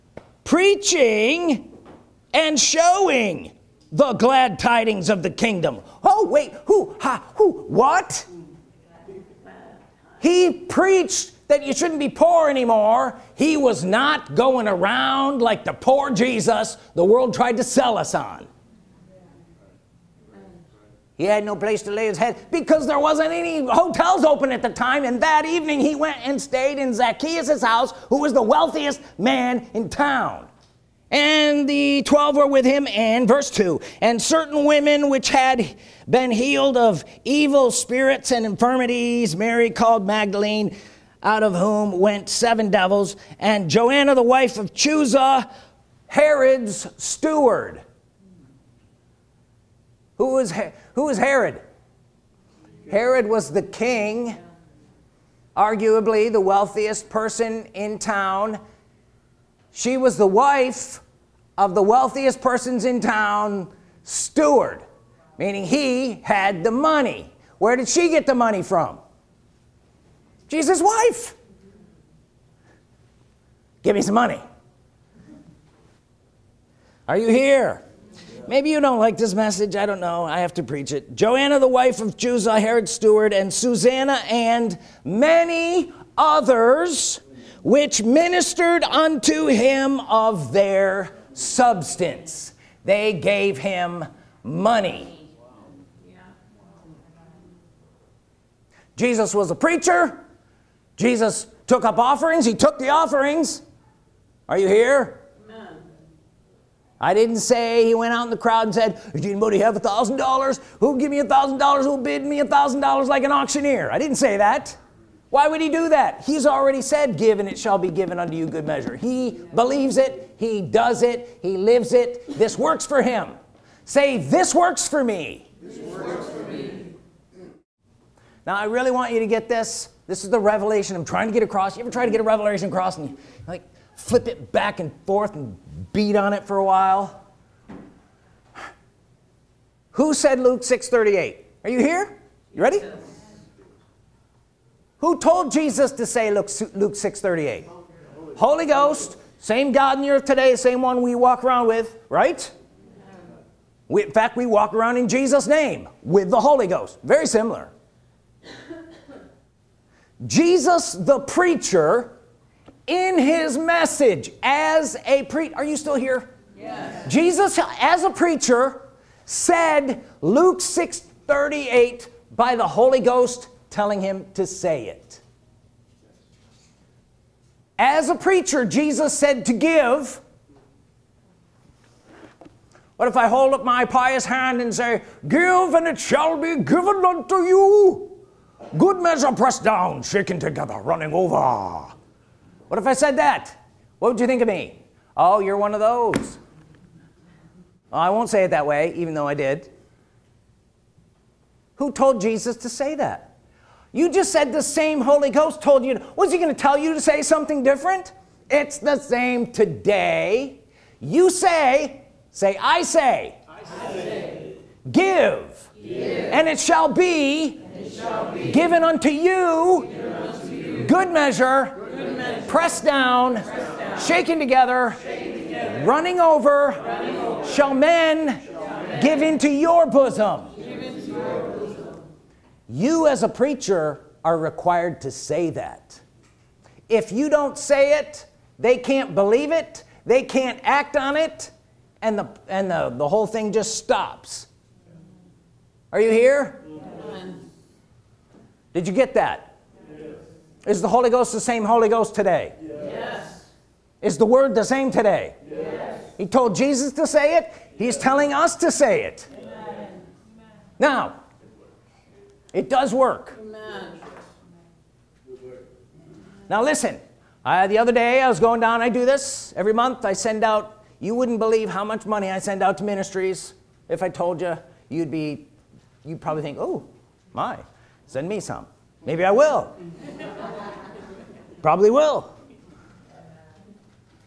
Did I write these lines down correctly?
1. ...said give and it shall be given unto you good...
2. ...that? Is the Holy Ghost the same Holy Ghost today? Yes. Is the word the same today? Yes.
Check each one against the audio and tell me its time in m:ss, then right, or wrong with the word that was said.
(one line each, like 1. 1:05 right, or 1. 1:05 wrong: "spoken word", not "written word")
1. 1:56 right
2. 4:09 right.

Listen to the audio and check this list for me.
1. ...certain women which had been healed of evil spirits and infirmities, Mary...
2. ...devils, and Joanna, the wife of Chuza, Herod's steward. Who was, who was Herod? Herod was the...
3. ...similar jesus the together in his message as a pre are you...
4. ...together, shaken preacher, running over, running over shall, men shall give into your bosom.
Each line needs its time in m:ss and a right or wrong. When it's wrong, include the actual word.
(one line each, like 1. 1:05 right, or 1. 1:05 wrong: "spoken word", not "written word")
1. 0:34 right
2. 0:42 right
3. 2:37 wrong: "preacher", not "together"
4. 3:44 wrong: "together", not "preacher".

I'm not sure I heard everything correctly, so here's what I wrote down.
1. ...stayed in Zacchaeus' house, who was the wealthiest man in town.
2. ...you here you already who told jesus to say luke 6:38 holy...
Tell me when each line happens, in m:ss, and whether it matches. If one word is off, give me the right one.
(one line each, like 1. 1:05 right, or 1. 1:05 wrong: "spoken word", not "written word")
1. 0:26 right
2. 2:21 wrong: "ready", not "already".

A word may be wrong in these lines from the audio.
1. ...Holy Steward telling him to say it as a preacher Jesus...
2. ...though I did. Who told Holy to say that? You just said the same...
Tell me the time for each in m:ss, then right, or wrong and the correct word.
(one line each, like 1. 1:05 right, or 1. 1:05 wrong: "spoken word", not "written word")
1. 2:52 wrong: "Ghost", not "Steward"
2. 3:19 wrong: "Jesus", not "Holy".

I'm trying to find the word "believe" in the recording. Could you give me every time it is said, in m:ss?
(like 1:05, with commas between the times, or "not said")
1:59, 3:59, 4:31.